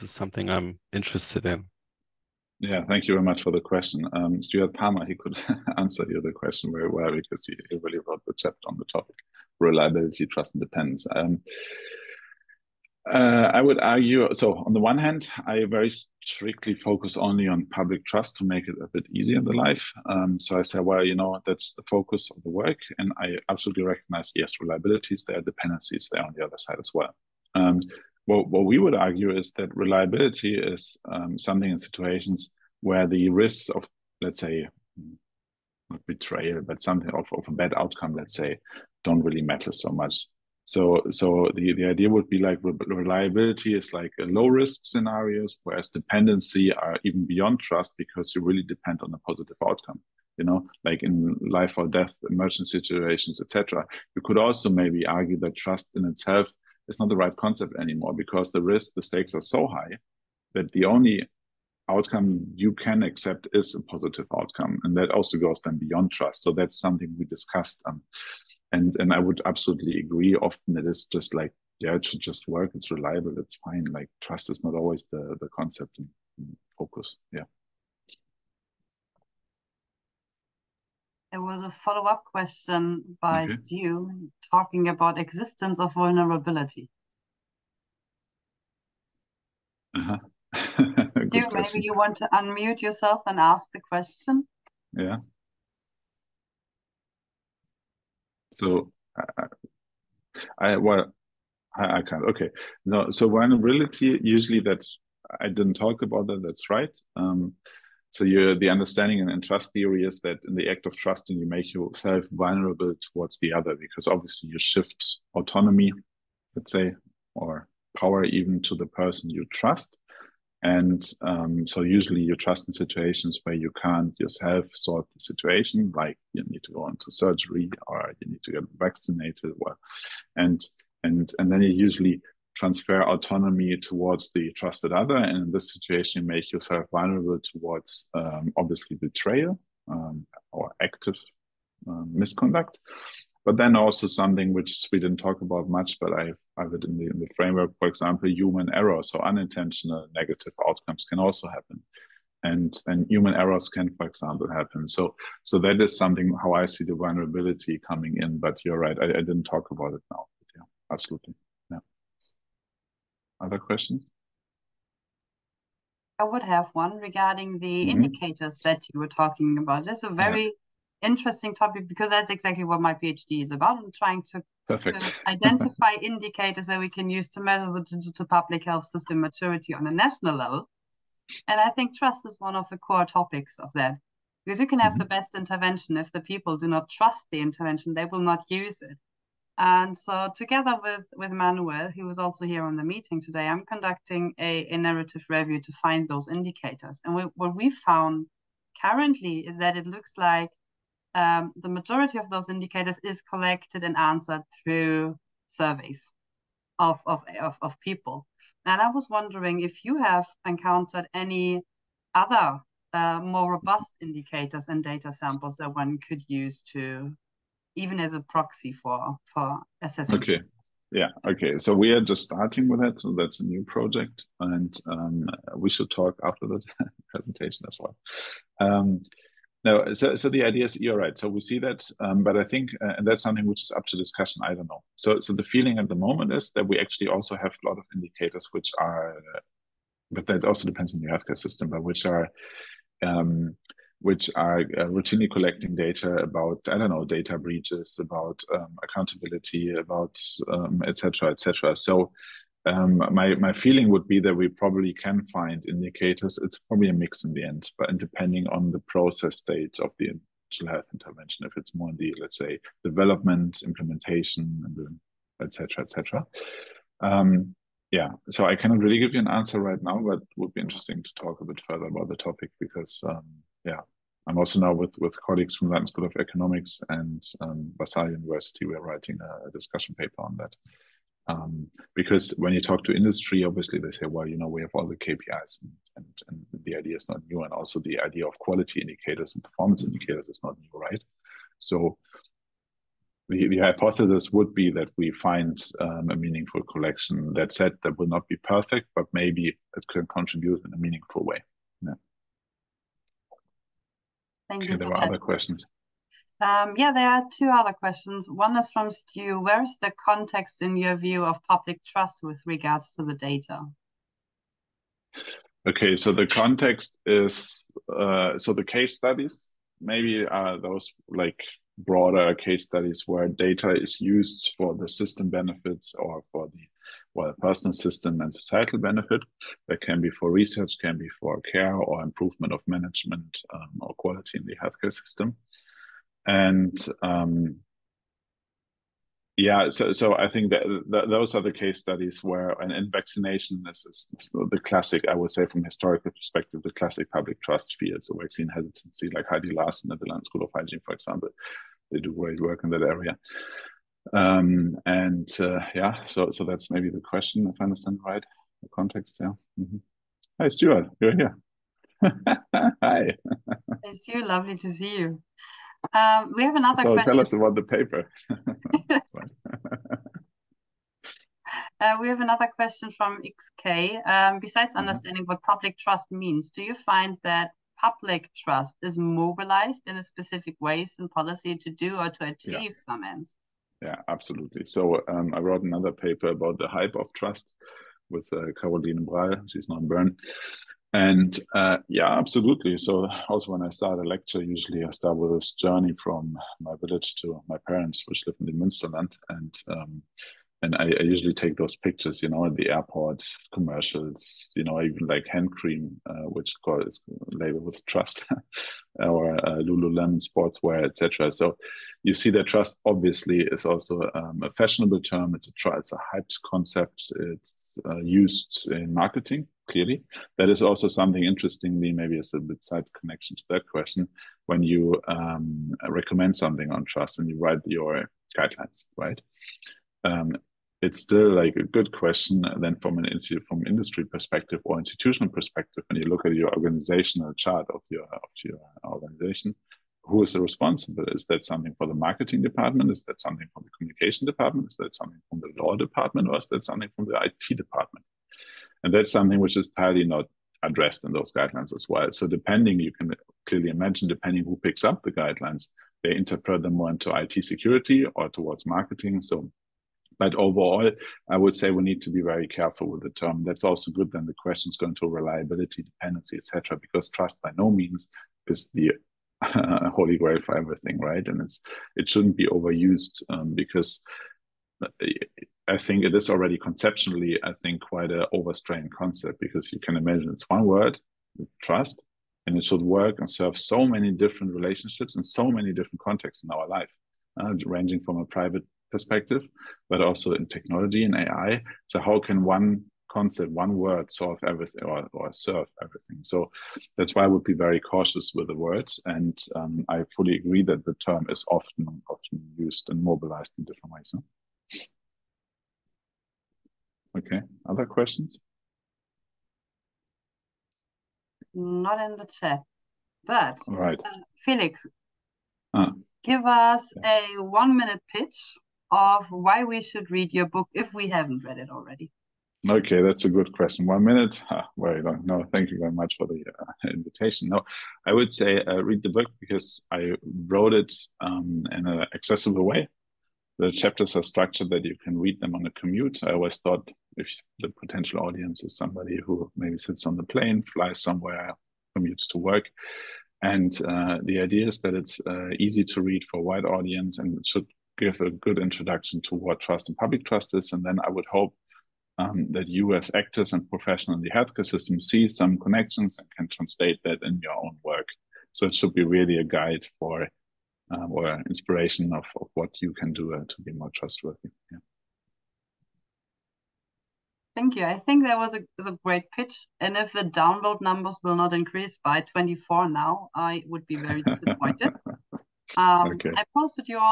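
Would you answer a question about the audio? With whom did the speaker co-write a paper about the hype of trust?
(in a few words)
Caroline Brall.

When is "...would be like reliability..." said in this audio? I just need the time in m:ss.
0:42.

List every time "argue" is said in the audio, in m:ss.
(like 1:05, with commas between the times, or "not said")
0:13, 0:28, 0:55.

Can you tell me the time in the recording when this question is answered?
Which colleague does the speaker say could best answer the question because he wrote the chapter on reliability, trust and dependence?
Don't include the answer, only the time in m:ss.
0:04.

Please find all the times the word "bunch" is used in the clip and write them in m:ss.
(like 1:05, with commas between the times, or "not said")
not said.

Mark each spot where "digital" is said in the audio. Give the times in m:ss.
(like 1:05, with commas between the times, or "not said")
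2:57, 4:20.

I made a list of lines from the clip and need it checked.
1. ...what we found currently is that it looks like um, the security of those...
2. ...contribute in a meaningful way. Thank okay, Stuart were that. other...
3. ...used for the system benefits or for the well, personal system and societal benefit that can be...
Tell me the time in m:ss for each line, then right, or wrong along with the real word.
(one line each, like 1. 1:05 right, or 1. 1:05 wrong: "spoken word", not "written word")
1. 3:17 wrong: "majority", not "security"
2. 5:00 wrong: "There", not "Stuart"
3. 5:24 right.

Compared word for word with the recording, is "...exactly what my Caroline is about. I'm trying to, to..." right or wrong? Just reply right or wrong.
wrong.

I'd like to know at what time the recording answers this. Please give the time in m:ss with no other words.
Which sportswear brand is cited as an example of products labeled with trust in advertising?
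6:49.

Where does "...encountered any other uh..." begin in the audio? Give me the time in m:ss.
3:30.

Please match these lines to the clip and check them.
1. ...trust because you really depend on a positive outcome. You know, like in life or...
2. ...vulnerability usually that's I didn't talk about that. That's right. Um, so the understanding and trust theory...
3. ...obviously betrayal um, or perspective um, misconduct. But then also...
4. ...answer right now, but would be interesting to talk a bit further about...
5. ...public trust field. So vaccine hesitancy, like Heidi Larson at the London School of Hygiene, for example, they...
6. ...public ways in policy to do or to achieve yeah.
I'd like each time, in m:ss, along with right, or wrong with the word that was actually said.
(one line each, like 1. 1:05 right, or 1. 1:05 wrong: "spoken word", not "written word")
1. 0:47 right
2. 1:43 right
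3. 2:18 wrong: "active", not "perspective"
4. 4:29 right
5. 5:47 right
6. 6:20 wrong: "specific", not "public".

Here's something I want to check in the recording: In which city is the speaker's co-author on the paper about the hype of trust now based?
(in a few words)
Bern.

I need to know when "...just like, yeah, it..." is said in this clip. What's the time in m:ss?
1:11.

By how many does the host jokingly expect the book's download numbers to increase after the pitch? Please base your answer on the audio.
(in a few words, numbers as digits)
24.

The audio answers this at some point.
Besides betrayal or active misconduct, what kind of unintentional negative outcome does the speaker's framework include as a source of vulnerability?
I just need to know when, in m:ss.
2:28.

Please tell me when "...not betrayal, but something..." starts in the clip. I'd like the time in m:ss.
0:35.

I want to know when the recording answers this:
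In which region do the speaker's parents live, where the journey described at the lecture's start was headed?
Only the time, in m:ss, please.
6:38.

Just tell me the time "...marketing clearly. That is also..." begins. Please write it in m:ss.
6:58.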